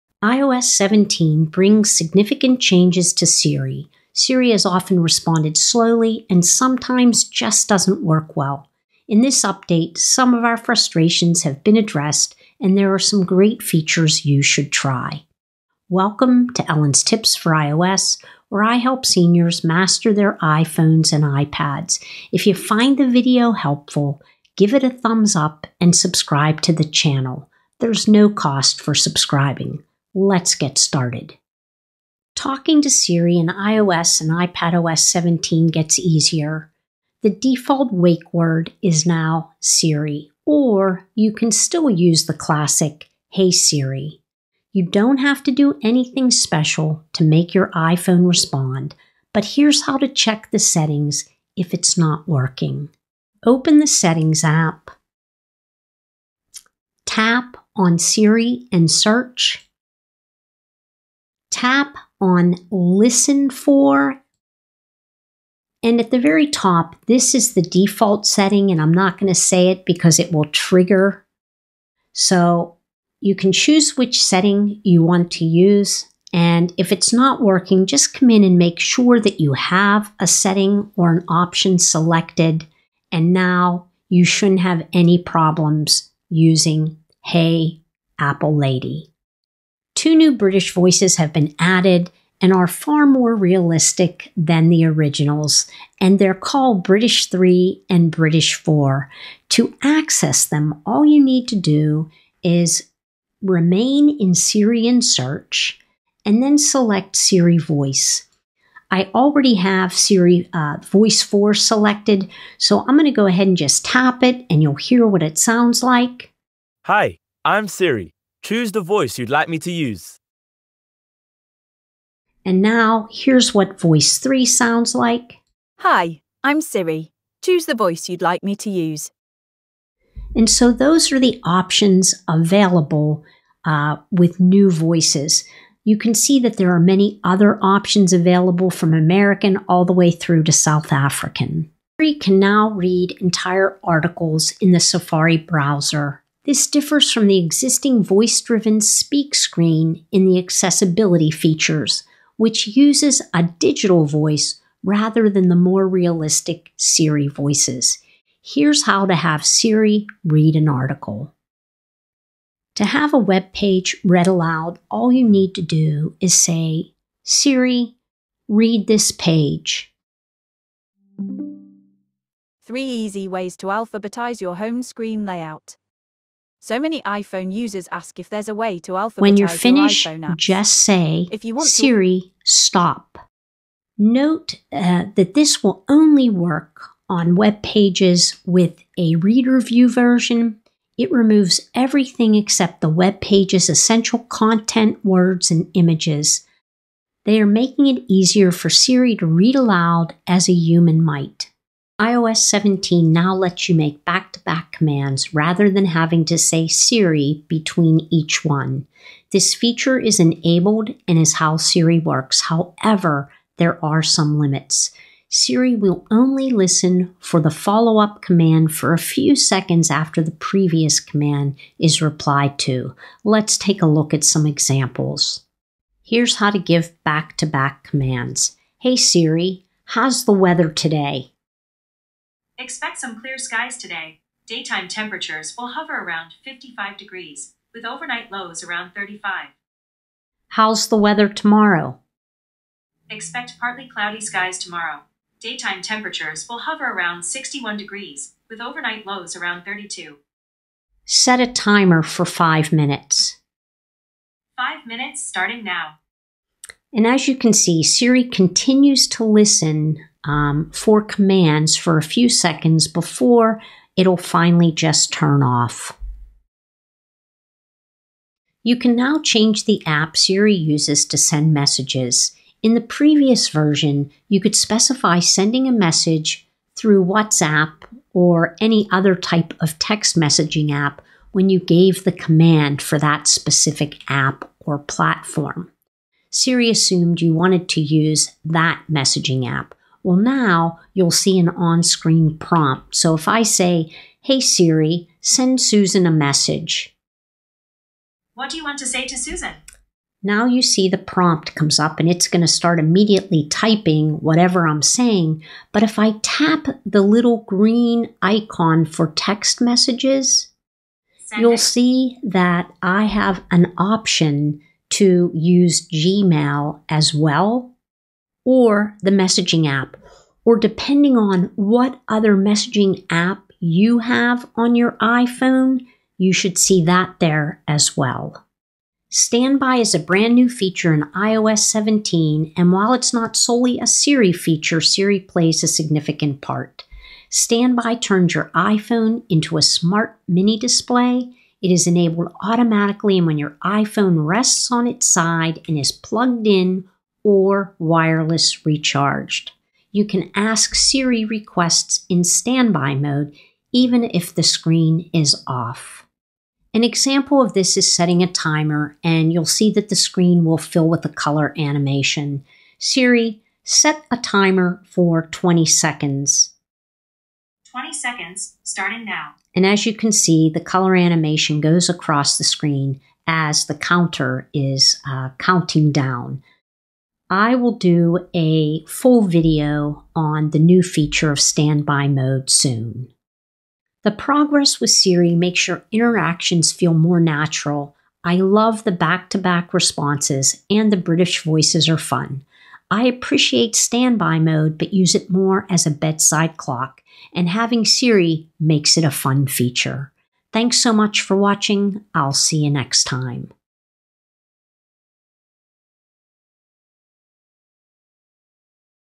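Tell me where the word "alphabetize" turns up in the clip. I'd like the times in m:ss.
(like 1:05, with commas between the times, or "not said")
2:53, 2:58.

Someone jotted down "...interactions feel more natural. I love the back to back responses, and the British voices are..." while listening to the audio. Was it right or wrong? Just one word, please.
right.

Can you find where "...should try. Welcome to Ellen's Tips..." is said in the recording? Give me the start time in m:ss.
0:14.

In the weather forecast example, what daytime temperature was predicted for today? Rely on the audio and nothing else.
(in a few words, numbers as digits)
55 degrees.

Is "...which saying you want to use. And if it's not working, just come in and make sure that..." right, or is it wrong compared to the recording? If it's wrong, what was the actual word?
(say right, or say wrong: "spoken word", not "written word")
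wrong: "setting", not "saying".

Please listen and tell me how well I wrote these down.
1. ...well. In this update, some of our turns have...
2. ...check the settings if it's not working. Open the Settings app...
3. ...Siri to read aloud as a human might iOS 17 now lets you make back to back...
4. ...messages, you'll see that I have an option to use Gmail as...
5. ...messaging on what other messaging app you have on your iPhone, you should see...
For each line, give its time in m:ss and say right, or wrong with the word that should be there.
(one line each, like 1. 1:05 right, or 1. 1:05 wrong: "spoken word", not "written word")
1. 0:08 wrong: "frustrations", not "turns"
2. 0:50 right
3. 3:18 right
4. 5:09 right
5. 5:20 wrong: "depending", not "messaging".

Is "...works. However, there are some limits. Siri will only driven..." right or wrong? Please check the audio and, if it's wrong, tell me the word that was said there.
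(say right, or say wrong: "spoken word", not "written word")
wrong: "listen", not "driven".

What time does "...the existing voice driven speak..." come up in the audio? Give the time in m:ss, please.
2:27.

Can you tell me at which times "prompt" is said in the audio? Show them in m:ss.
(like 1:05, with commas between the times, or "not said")
4:52, 5:00.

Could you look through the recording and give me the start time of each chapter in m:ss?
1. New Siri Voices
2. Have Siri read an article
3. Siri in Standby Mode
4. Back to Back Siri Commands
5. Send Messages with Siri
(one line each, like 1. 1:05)
1. 1:28
2. 2:21
3. 5:28
4. 3:21
5. 4:26.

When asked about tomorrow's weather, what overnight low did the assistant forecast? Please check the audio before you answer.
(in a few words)
32.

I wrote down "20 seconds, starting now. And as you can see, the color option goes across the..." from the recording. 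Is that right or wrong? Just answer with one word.
wrong.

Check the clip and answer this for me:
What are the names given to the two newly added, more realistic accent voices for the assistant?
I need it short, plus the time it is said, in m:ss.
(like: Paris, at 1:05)
British 3 and British 4, at 1:36.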